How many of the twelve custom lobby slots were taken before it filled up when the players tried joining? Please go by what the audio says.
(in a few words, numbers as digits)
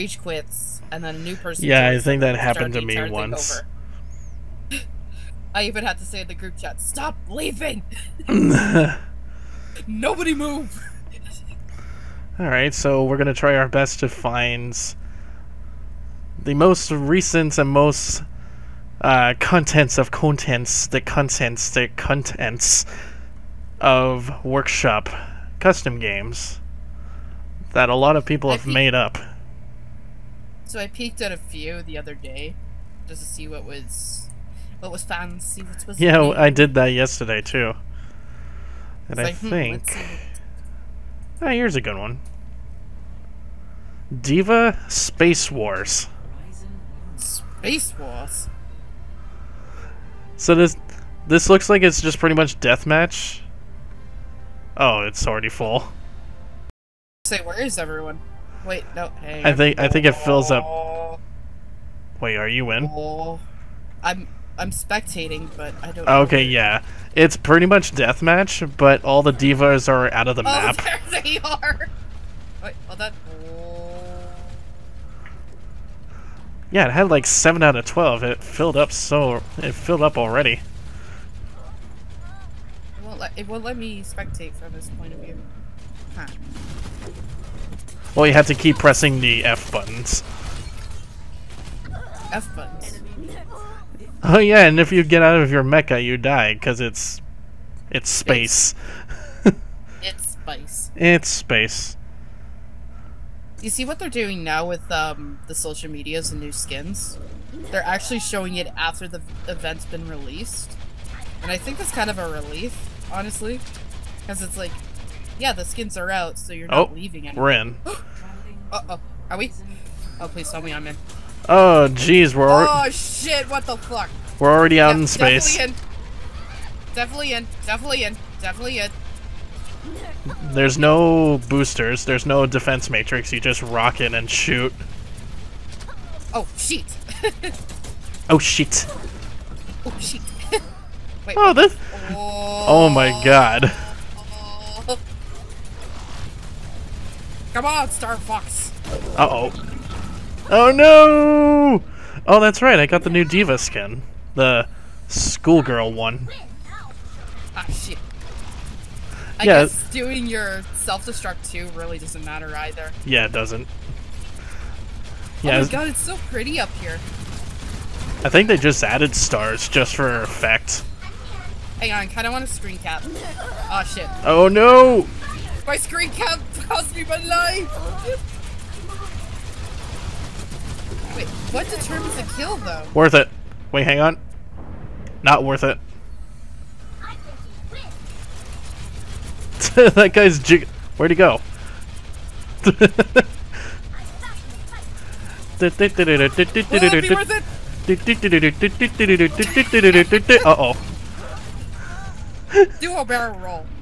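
7.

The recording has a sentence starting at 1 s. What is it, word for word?
Yeah, I think that happened to me once.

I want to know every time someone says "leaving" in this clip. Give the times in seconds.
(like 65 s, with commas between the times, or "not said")
7 s, 116 s.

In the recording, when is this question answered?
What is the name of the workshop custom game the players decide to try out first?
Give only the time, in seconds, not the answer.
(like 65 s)
44 s.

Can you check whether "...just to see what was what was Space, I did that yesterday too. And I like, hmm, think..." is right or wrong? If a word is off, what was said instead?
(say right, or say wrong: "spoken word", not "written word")
wrong: "Yeah", not "Space".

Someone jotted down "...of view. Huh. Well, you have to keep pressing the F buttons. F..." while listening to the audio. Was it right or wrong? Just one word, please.
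right.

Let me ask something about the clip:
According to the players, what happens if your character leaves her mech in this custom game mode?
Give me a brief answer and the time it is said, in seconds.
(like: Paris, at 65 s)
You die, at 96 s.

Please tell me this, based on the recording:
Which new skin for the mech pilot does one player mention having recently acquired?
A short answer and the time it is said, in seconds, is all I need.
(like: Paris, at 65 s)
The schoolgirl one, at 154 s.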